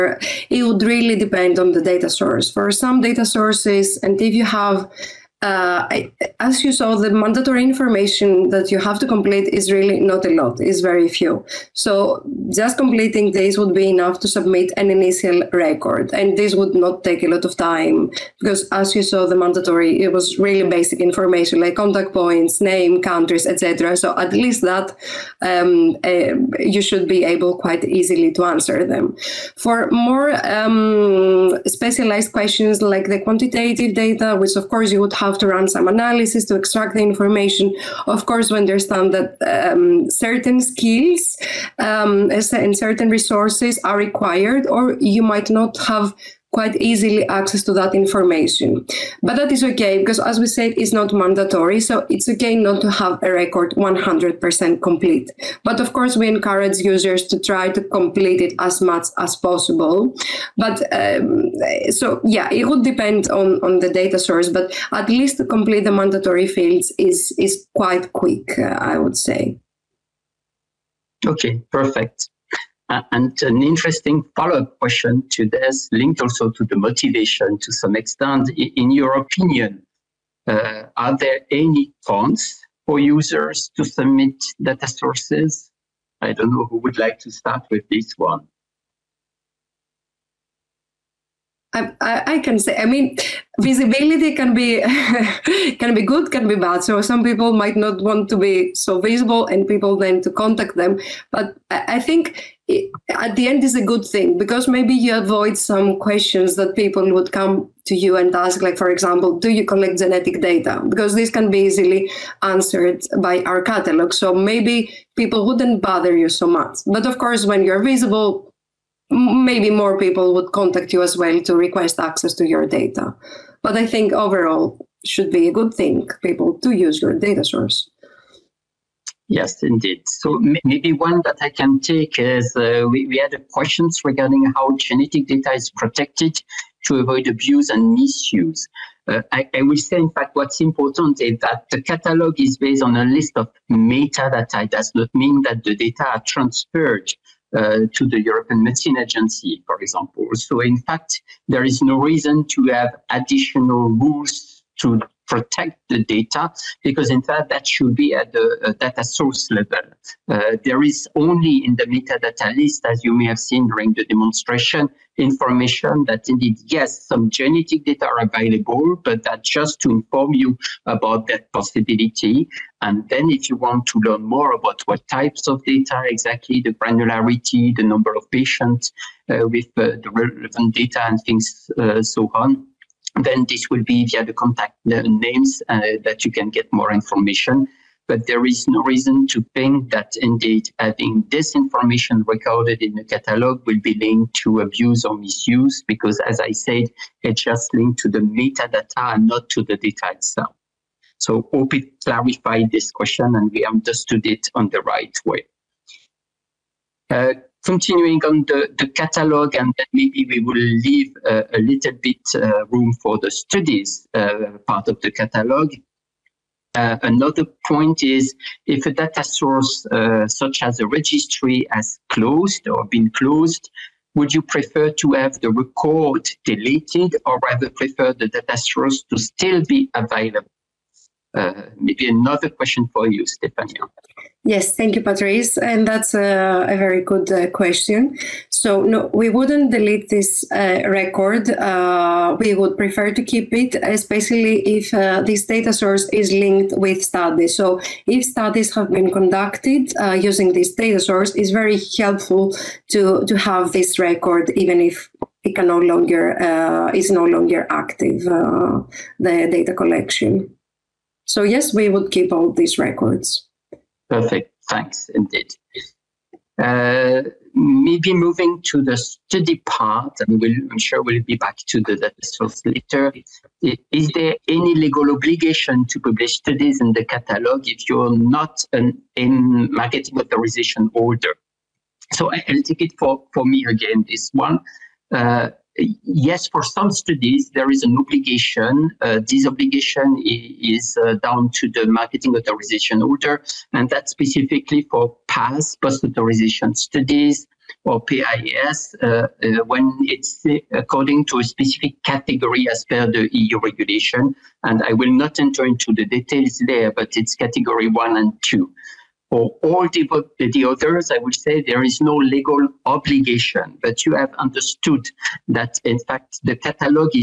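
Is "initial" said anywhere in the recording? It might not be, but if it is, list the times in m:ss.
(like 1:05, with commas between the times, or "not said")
0:14.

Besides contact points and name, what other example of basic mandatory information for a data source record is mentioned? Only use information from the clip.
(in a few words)
countries.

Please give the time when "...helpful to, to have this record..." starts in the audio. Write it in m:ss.
4:11.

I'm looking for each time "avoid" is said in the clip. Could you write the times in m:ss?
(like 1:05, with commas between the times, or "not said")
1:45, 2:17.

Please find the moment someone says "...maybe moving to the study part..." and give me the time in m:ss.
4:27.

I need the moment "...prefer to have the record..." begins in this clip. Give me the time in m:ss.
3:44.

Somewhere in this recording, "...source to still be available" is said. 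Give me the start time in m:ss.
3:48.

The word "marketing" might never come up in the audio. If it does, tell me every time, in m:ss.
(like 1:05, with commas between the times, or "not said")
4:39, 4:51.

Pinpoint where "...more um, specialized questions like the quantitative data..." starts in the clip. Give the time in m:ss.
0:29.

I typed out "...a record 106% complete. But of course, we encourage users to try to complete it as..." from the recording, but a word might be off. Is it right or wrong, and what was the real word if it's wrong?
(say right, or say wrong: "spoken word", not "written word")
wrong: "100", not "106".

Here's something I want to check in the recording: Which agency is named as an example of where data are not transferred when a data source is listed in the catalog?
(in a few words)
European Medicine Agency.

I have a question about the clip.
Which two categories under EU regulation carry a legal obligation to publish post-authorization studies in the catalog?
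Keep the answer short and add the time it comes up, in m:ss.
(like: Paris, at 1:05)
category 1 and 2, at 5:07.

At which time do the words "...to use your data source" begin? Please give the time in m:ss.
2:06.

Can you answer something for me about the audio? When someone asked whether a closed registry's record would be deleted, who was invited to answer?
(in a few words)
Stefania.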